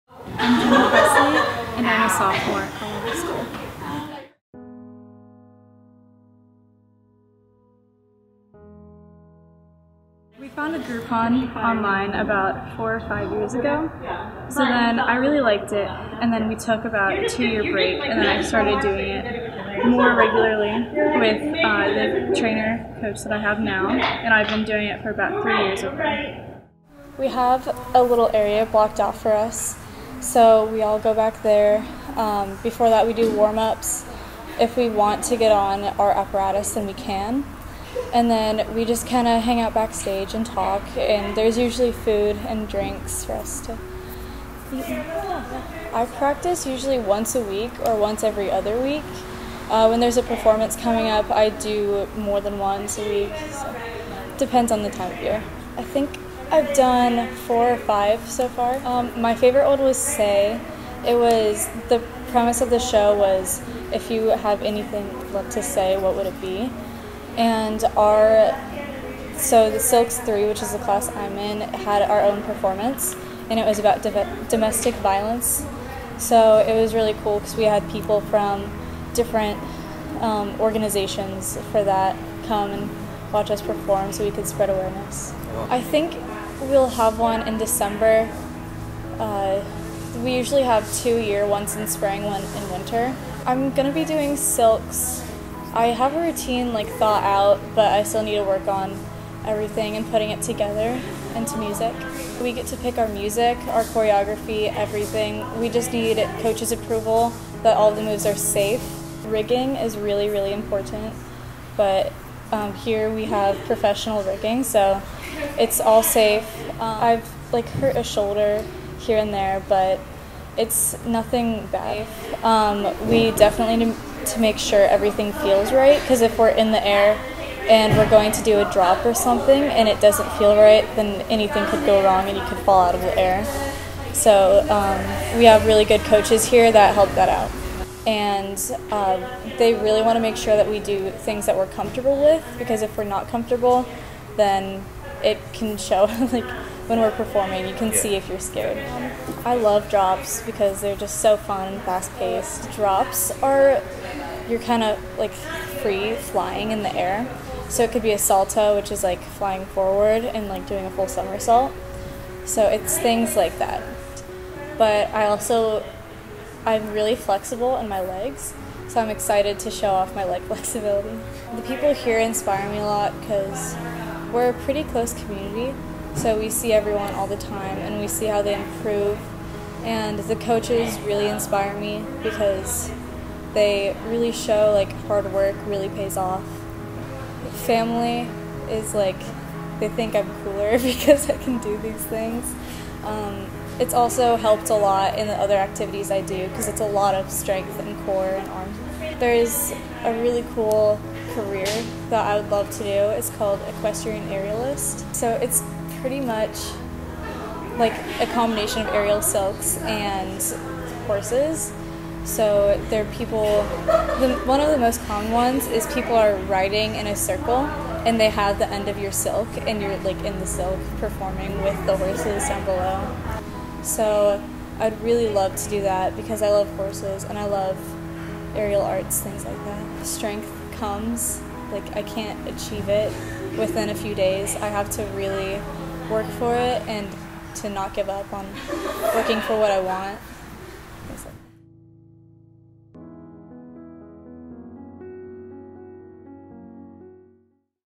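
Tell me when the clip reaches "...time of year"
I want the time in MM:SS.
00:54.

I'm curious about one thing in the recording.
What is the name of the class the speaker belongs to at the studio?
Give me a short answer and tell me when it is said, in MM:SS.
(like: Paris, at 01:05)
Silks Three, at 01:09.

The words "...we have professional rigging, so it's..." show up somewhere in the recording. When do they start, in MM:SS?
01:53.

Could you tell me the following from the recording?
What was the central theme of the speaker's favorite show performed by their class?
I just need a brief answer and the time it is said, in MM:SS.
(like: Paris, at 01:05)
Domestic violence, at 01:14.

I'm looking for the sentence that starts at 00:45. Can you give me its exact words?
I practice usually once a week or once every other week.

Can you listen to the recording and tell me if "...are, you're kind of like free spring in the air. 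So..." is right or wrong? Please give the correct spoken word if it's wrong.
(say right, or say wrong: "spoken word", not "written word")
wrong: "flying", not "spring".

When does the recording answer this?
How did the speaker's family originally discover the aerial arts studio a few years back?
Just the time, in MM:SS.
00:10.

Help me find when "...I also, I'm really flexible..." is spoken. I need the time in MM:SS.
02:45.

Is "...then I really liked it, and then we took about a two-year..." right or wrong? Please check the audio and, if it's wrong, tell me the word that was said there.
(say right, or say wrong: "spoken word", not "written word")
right.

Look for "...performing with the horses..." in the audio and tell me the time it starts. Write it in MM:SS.
03:40.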